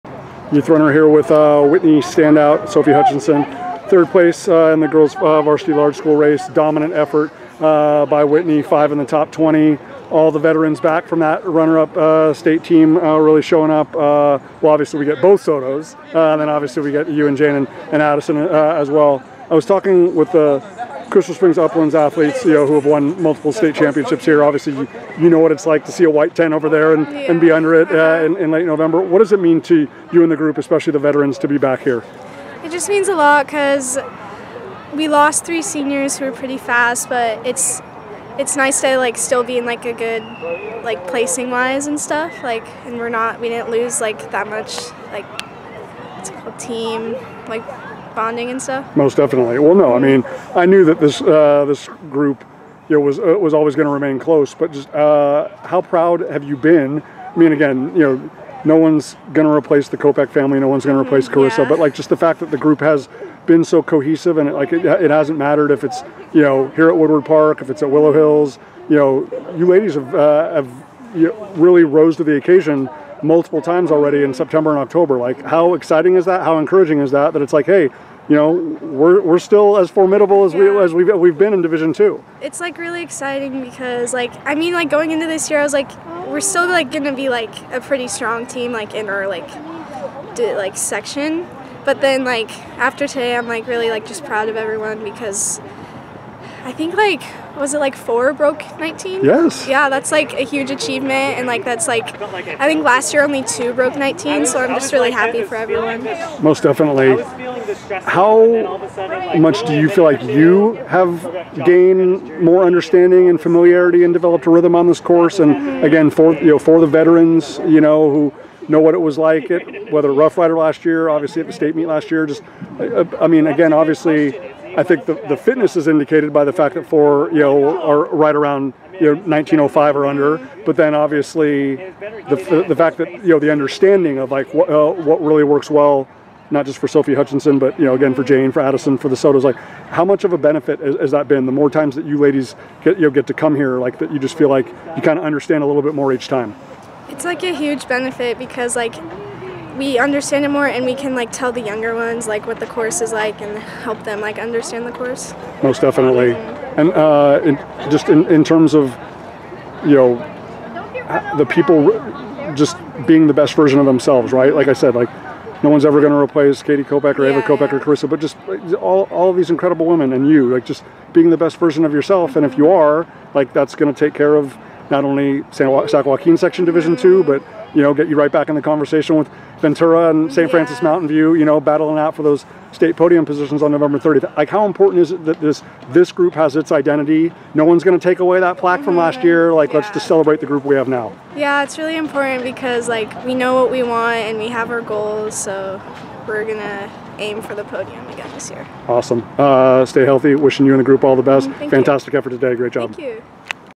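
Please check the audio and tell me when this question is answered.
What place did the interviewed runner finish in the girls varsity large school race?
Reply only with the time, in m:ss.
0:03.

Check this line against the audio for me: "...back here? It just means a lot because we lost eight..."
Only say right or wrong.
wrong.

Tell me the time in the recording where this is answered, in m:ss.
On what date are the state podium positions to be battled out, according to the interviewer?
3:03.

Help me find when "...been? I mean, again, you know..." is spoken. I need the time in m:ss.
0:56.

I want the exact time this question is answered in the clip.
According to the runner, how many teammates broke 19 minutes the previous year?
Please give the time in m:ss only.
1:43.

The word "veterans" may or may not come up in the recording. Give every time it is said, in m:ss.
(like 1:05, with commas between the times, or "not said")
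0:10, 0:30, 1:56.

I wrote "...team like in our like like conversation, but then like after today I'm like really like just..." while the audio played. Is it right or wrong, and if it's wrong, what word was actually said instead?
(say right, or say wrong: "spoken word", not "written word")
wrong: "section", not "conversation".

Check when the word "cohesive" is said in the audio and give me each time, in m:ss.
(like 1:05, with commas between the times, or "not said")
1:03.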